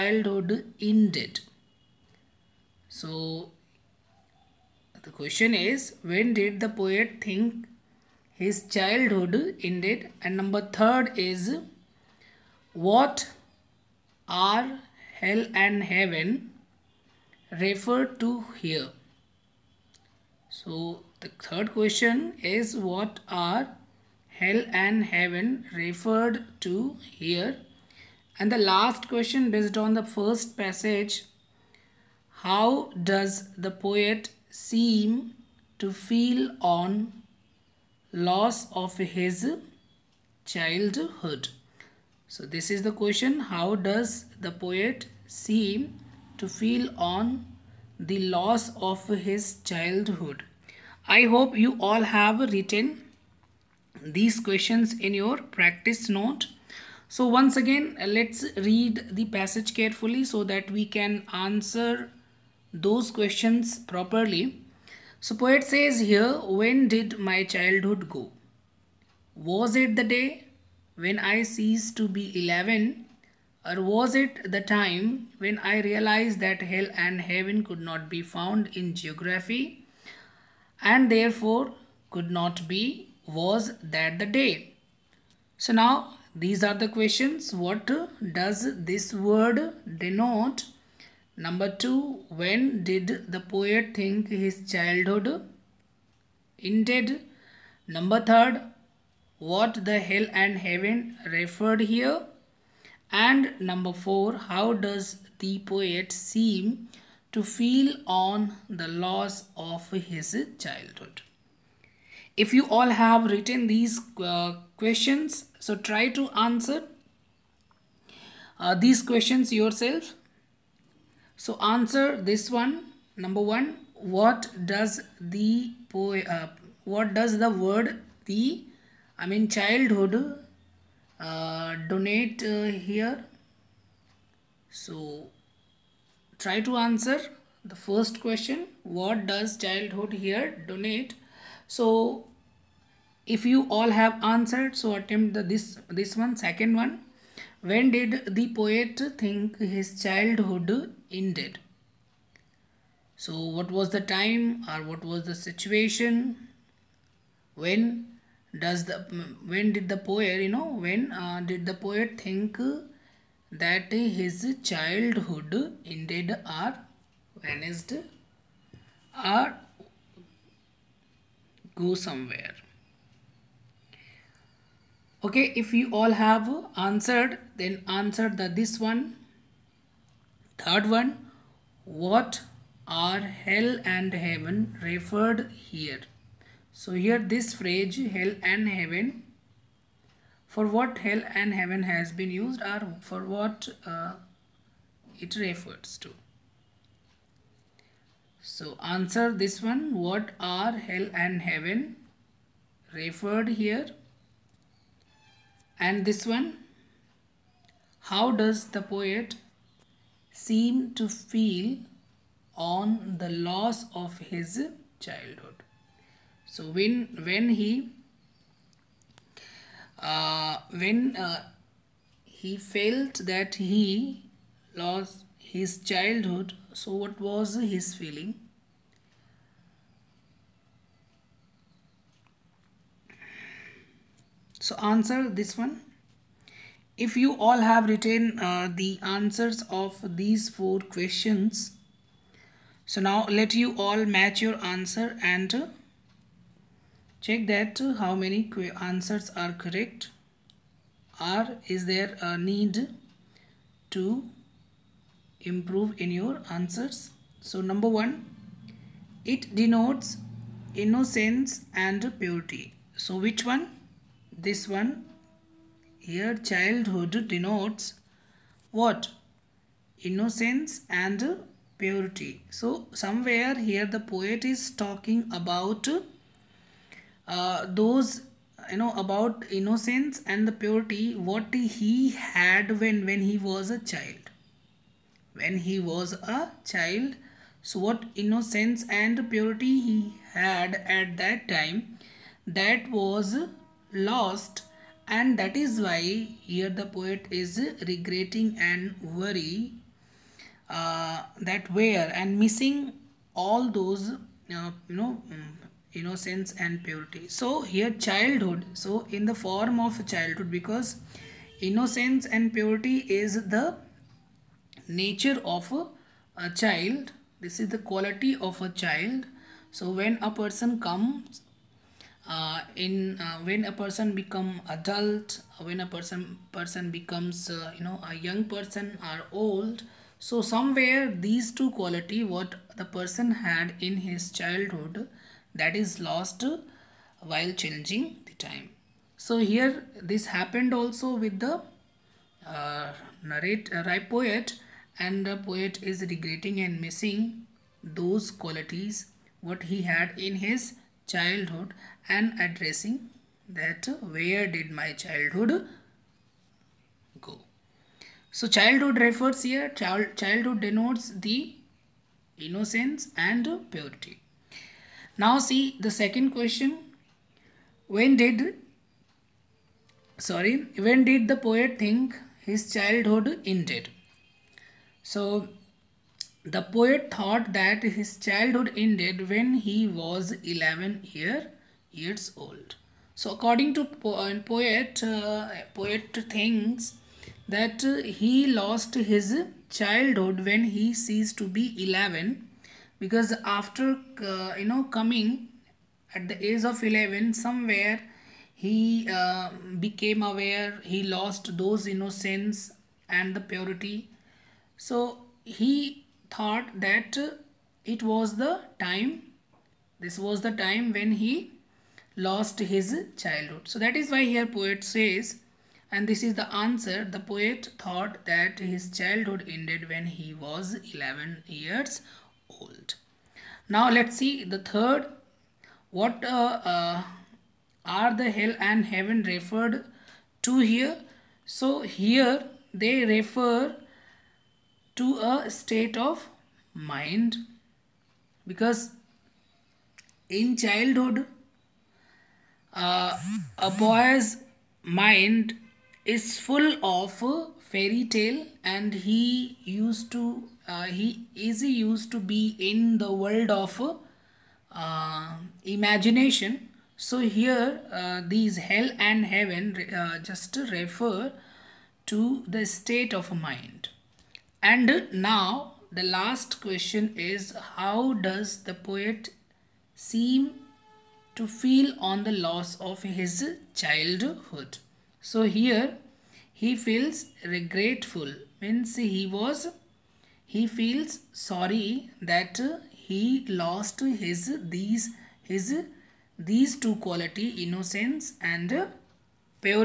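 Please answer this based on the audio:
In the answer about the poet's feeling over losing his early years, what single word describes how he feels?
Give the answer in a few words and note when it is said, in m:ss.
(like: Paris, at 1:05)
Regretful, at 7:57.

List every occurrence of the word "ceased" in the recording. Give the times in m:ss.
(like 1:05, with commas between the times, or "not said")
1:11, 6:30.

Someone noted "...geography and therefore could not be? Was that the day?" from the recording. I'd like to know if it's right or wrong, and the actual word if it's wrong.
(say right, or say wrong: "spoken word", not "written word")
right.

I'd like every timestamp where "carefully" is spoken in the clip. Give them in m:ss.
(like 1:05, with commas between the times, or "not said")
0:59.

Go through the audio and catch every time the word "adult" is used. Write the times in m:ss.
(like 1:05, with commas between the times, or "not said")
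5:24.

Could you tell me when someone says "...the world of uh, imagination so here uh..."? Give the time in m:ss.
7:32.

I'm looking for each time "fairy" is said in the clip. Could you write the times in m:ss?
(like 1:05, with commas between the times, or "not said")
7:27.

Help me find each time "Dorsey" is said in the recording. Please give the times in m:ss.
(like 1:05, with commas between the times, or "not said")
not said.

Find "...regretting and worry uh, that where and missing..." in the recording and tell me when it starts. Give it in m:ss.
4:57.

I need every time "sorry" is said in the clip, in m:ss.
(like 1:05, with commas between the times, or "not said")
6:10, 8:01.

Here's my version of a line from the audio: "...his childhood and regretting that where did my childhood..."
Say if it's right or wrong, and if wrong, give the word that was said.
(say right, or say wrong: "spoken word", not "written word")
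wrong: "addressing", not "regretting".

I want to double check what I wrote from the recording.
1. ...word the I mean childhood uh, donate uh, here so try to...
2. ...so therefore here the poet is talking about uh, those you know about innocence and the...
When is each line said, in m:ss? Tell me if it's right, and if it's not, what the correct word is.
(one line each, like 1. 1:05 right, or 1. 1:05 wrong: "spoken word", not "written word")
1. 2:07 right
2. 4:32 wrong: "somewhere", not "therefore".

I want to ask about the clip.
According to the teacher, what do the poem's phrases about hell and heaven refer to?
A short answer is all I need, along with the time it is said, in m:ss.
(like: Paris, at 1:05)
A state of mind, at 7:15.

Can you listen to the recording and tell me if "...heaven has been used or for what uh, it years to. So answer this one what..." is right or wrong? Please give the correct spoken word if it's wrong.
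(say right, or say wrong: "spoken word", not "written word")
wrong: "refers", not "years".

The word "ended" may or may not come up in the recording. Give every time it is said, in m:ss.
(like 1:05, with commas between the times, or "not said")
0:00, 0:09, 1:36, 2:31, 2:45, 6:13, 6:18, 6:59.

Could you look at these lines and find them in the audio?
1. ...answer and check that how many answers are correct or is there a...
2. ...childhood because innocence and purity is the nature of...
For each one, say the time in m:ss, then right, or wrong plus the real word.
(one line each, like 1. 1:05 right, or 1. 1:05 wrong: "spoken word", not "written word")
1. 4:04 right
2. 5:10 right.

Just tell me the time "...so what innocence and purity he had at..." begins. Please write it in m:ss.
4:47.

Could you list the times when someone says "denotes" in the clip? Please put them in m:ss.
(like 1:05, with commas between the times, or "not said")
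1:29, 4:19, 4:27, 6:00.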